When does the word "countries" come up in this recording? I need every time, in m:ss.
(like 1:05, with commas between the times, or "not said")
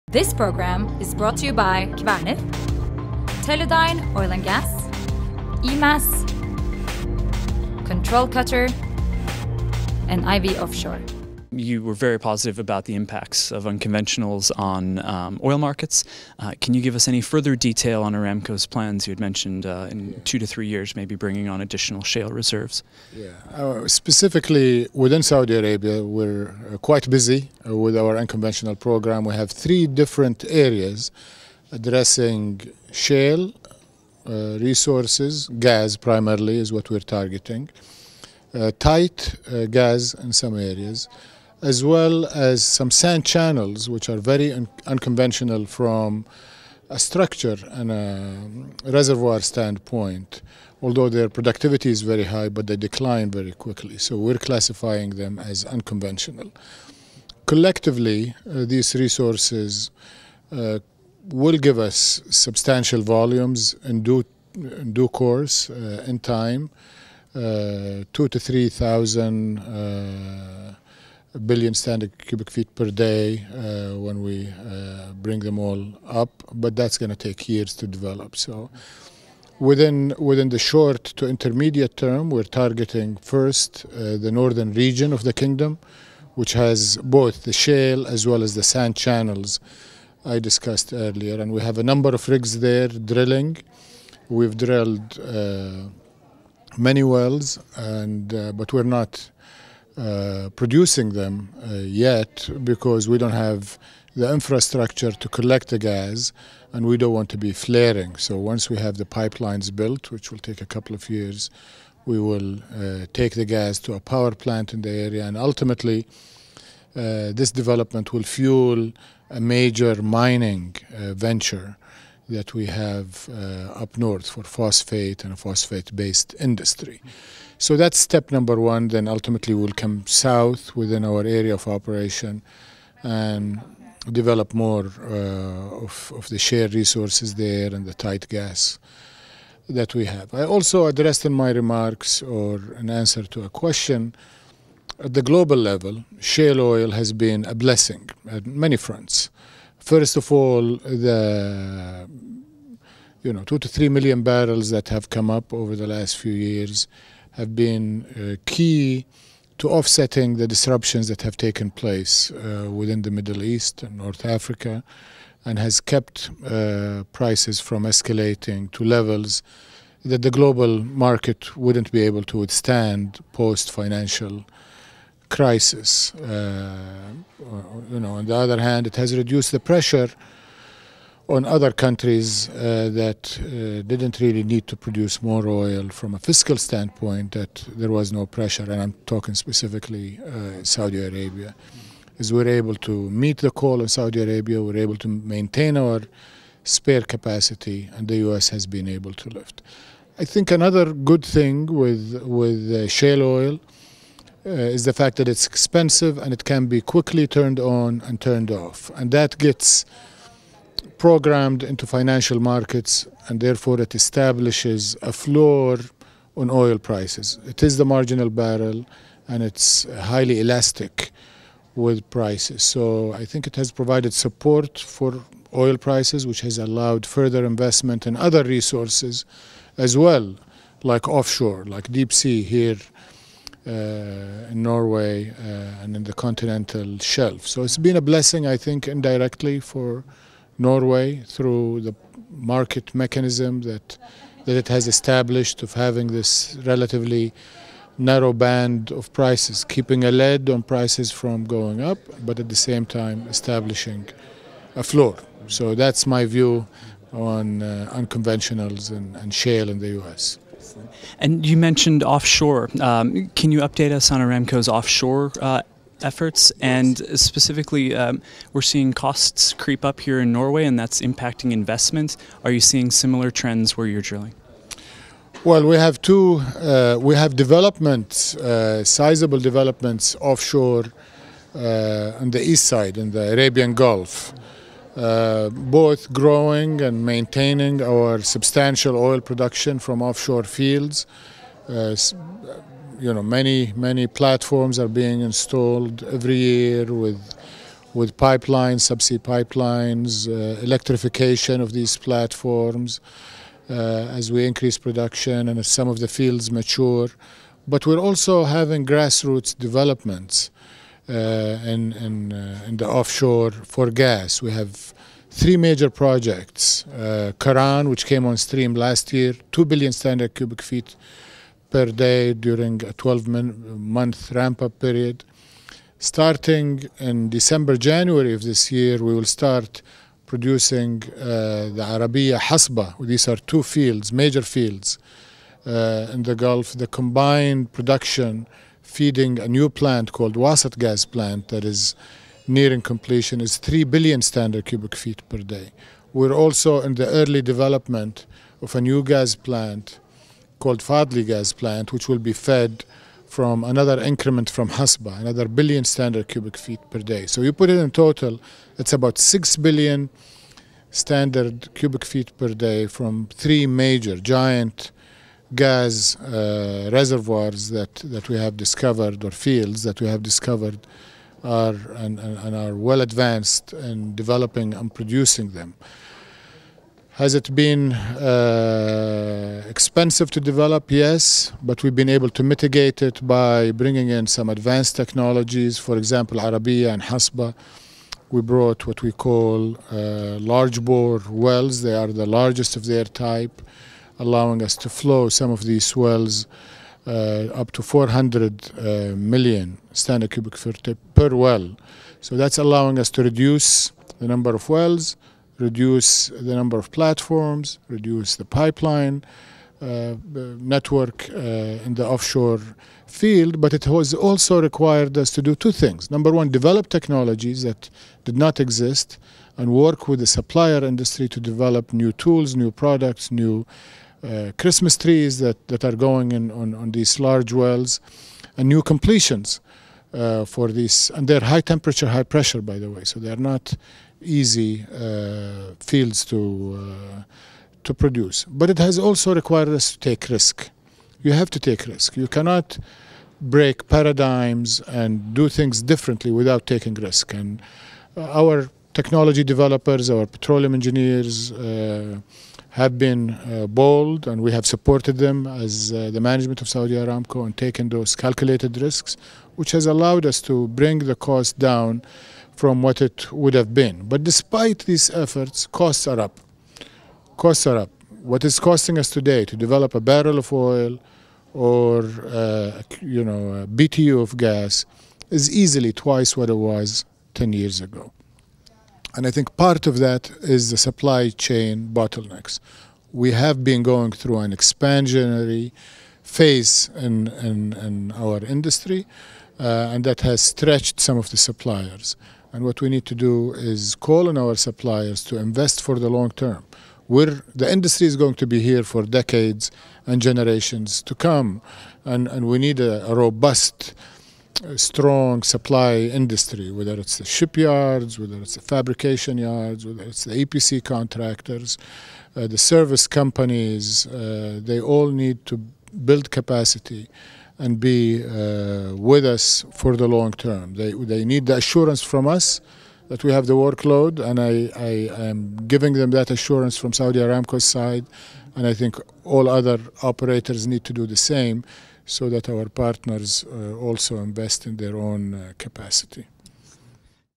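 3:01.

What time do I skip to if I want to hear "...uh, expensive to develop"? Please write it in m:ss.
6:17.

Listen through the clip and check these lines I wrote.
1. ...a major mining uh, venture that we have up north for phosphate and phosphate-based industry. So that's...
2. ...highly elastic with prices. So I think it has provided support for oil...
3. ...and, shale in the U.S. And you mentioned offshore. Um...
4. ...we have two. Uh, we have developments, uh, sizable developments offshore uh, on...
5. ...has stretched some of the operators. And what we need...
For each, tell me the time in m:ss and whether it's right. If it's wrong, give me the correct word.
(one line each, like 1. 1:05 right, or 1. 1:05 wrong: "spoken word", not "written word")
1. 1:59 right
2. 3:40 right
3. 4:19 right
4. 4:35 right
5. 8:10 wrong: "suppliers", not "operators".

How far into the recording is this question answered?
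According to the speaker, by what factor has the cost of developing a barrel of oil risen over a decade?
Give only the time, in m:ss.
7:56.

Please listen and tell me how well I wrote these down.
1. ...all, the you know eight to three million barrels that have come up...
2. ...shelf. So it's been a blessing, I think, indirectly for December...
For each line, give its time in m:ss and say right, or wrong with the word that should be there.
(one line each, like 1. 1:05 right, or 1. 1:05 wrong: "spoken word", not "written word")
1. 2:30 wrong: "two", not "eight"
2. 3:56 wrong: "Norway", not "December".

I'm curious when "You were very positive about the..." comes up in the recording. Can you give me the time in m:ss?
0:11.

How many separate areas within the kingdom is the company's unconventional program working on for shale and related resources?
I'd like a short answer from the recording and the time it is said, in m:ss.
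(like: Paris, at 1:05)
3, at 0:29.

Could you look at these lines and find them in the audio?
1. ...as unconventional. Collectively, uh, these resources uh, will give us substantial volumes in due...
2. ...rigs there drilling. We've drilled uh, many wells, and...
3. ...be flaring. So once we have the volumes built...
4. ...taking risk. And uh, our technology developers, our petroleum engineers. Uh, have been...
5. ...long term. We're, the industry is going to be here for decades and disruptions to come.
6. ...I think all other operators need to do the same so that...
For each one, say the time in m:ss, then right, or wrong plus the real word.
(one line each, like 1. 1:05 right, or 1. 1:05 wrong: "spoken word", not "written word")
1. 0:55 right
2. 1:32 right
3. 1:47 wrong: "pipelines", not "volumes"
4. 7:26 right
5. 8:16 wrong: "generations", not "disruptions"
6. 8:48 right.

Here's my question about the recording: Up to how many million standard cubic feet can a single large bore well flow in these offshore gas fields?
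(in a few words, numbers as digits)
400.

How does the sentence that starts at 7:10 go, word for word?
Uh, for these, and they're high temperature, high pressure, by the way, so they're not easy uh, fields to uh, to produce.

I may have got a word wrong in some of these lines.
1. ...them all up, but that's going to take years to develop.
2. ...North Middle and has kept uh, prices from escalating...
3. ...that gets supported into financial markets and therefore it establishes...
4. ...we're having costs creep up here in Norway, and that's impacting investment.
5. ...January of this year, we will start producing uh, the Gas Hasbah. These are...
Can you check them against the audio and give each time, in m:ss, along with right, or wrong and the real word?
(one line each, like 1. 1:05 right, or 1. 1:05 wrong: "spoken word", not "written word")
1. 1:15 right
2. 2:43 wrong: "Africa", not "Middle"
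3. 3:29 wrong: "programmed", not "supported"
4. 4:28 wrong: "seeing", not "having"
5. 5:27 wrong: "Arabiyah", not "Gas".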